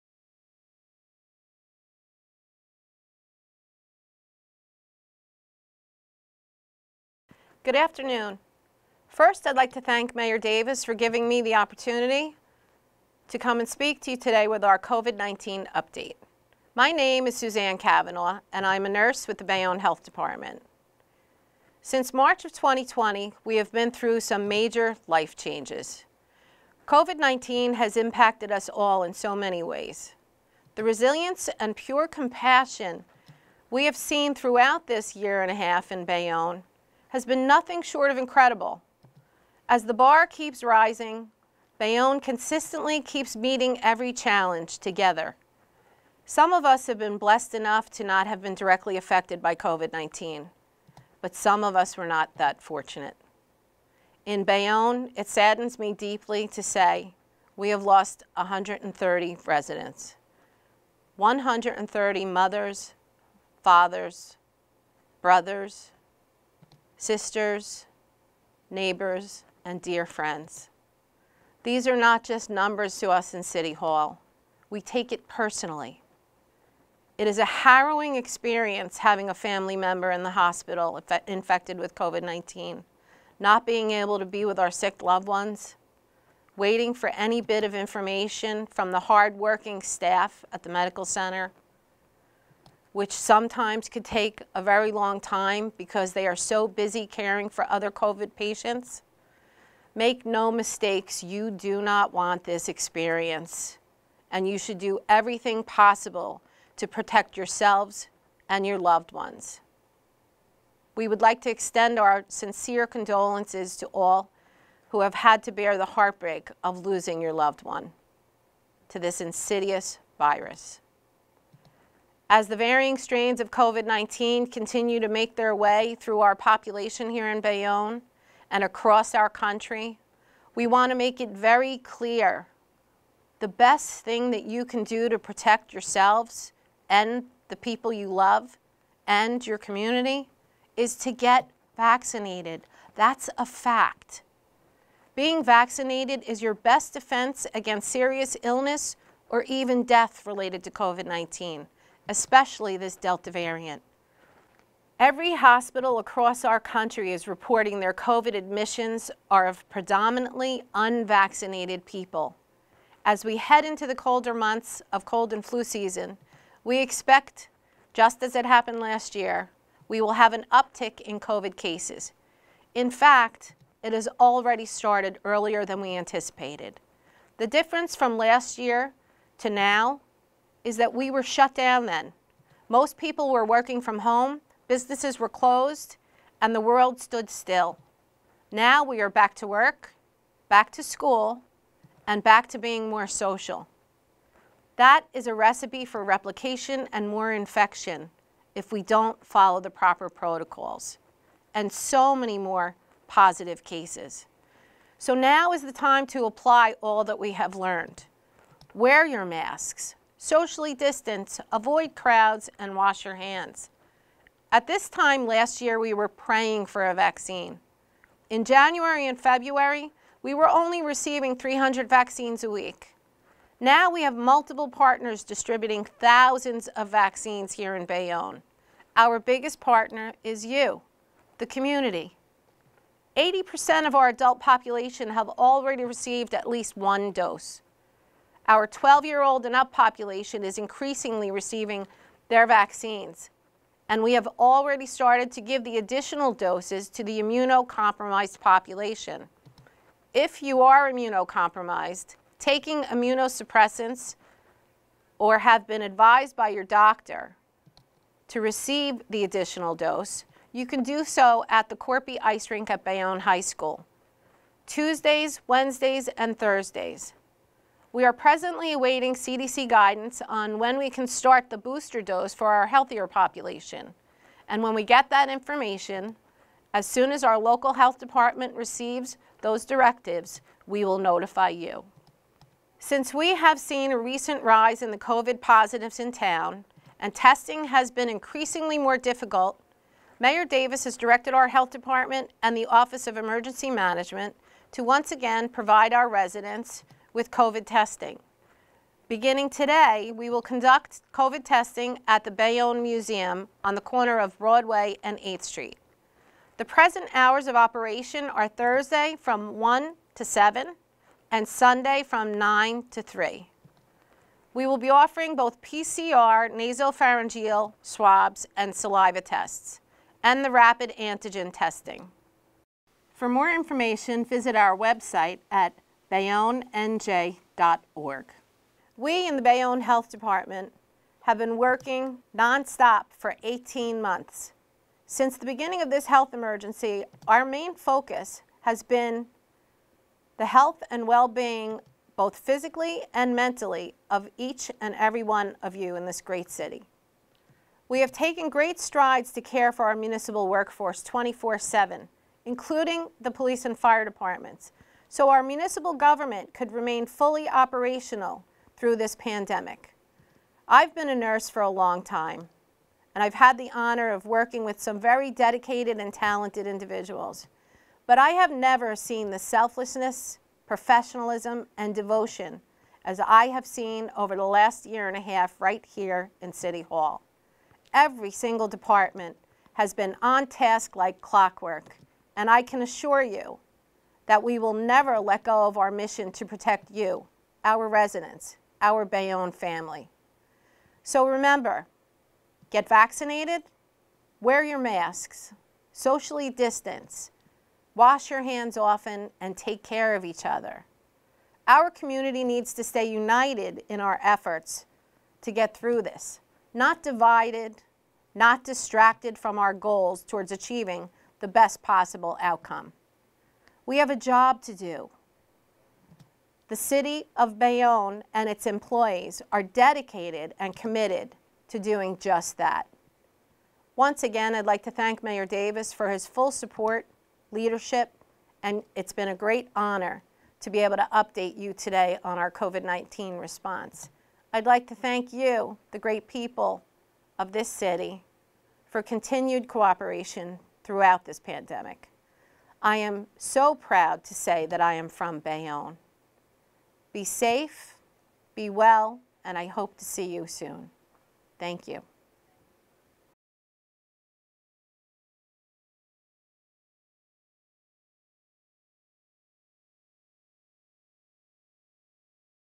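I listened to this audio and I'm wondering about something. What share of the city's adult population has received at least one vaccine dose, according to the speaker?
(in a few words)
80%.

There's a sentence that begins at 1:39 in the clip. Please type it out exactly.
Make no mistakes, you do not want this experience, and you should do everything possible to protect yourselves and your loved ones.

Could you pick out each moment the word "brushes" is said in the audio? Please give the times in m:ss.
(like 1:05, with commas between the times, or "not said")
not said.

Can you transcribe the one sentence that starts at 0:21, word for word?
Since March of 2020, we have been through some major life changes.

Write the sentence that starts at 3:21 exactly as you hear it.
And so many more positive cases.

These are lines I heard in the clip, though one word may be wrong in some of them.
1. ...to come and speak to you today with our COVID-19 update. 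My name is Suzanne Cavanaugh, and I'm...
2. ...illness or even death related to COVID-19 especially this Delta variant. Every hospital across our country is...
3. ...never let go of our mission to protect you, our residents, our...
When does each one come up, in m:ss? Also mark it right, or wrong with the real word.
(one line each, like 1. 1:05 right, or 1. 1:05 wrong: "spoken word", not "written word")
1. 0:13 right
2. 2:28 right
3. 6:24 right.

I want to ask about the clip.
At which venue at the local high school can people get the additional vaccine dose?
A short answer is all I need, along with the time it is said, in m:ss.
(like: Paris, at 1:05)
Korpi Ice Rink, at 4:21.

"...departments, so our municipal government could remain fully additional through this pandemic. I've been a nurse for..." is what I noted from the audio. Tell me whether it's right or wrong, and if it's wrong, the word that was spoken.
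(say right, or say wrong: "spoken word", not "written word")
wrong: "operational", not "additional".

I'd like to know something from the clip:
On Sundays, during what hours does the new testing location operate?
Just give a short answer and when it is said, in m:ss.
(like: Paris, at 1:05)
9 to 3, at 5:12.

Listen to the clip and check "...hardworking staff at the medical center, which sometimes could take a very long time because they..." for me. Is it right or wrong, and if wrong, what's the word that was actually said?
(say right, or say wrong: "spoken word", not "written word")
right.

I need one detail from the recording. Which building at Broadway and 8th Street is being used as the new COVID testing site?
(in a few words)
Bayonne Museum.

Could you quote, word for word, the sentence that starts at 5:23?
For more information, visit our website at bayonnenj.org.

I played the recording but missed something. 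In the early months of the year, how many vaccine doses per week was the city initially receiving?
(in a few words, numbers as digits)
300.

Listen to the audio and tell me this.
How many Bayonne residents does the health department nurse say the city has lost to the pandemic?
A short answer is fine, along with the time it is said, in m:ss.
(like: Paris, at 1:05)
130, at 0:58.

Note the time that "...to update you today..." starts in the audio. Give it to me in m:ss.
7:10.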